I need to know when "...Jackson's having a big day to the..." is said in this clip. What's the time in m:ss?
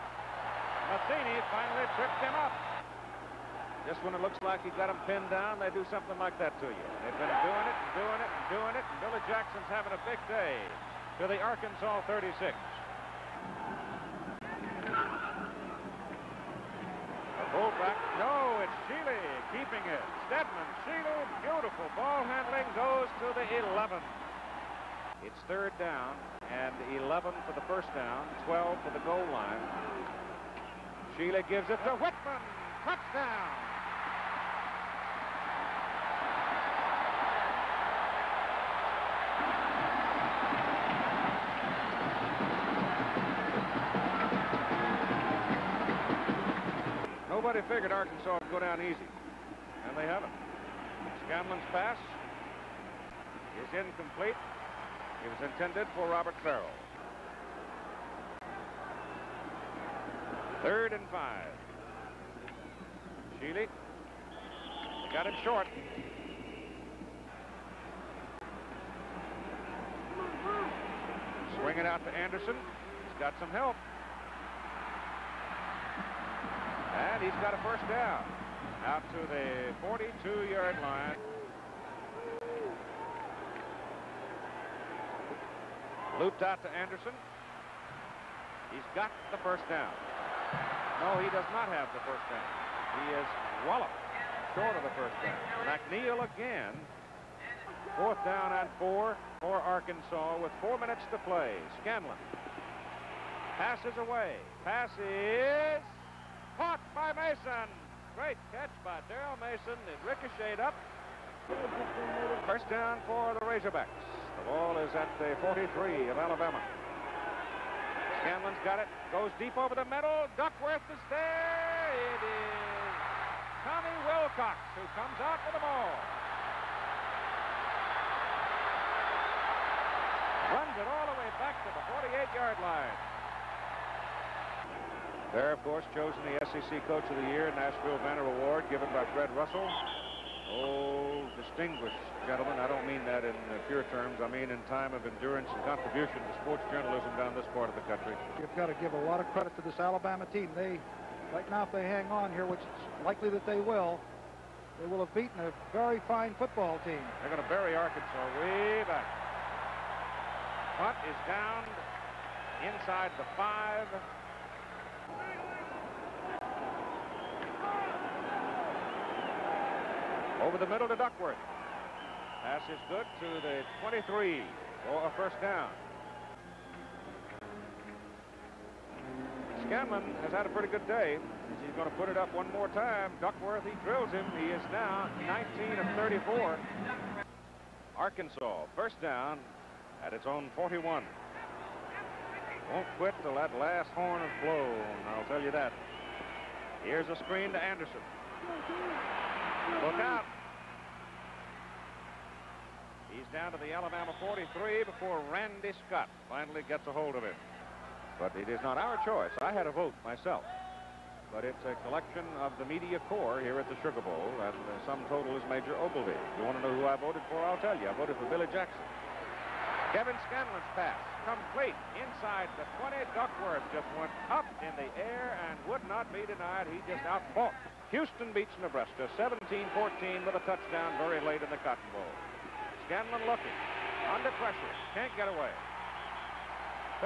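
0:09.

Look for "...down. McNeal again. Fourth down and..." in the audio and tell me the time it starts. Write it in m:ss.
1:35.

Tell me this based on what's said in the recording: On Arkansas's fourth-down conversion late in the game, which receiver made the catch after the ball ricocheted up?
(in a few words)
Daryl Mason.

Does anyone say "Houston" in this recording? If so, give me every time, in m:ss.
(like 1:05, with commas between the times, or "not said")
3:47.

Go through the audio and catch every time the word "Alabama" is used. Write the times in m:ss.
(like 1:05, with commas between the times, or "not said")
1:56, 2:29, 3:23.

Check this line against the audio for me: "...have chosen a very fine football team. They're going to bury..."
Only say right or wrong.
wrong.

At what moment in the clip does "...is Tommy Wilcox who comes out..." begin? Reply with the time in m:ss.
2:02.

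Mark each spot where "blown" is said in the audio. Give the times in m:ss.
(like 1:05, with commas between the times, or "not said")
3:14.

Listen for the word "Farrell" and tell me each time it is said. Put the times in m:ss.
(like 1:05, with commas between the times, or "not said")
0:56.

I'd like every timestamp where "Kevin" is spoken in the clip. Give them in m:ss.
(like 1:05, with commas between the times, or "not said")
3:39.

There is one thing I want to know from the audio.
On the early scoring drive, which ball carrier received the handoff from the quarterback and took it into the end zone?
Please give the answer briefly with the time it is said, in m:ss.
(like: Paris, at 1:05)
Whitman, at 0:31.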